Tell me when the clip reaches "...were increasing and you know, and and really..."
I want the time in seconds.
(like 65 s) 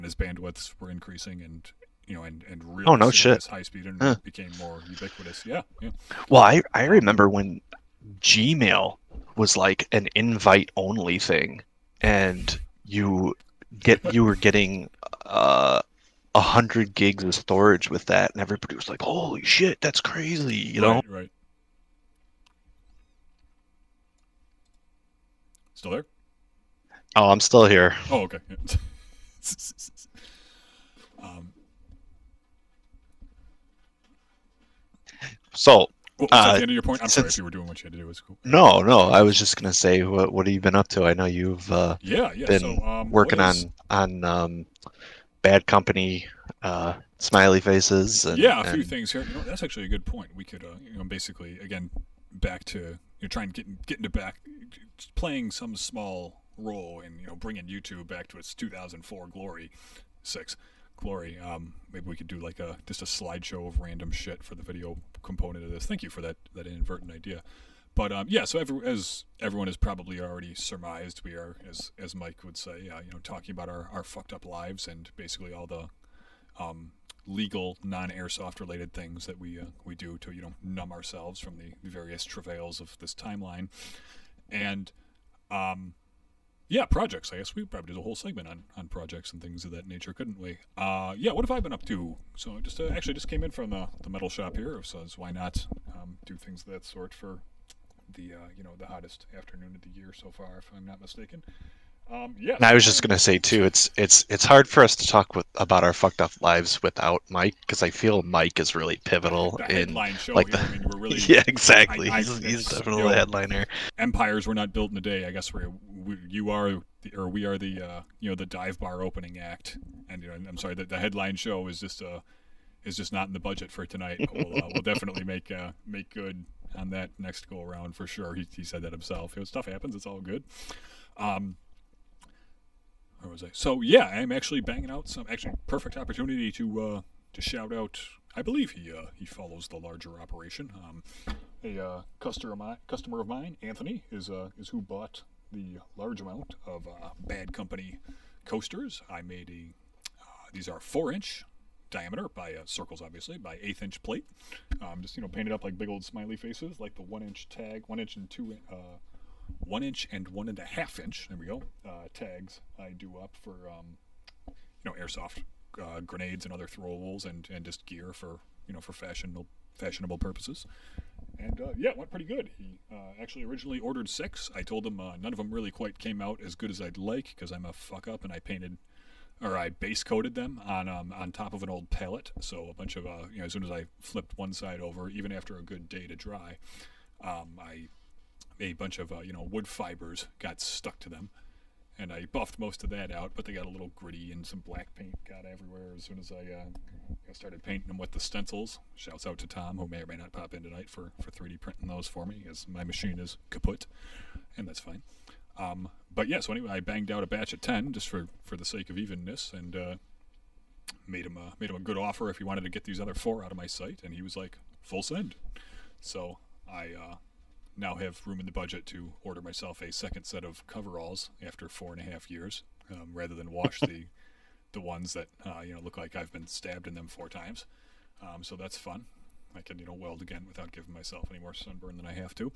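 0 s.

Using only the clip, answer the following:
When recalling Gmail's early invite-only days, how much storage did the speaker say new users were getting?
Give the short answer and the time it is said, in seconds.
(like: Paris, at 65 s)
100 gigs, at 16 s.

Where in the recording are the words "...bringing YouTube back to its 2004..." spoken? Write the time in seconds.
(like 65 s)
57 s.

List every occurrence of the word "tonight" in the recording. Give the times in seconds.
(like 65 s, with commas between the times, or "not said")
123 s, 200 s.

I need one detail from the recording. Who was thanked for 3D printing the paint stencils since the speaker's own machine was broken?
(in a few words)
Tom.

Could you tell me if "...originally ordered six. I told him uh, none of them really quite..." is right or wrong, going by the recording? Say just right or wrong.
right.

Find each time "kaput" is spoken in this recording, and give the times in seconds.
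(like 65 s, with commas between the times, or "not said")
203 s.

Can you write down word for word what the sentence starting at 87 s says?
I guess we probably did a whole segment on, on projects and things of that nature, couldn't we?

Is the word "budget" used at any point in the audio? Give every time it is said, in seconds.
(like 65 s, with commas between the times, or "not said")
123 s, 218 s.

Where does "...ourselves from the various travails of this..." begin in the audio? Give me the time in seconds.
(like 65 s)
80 s.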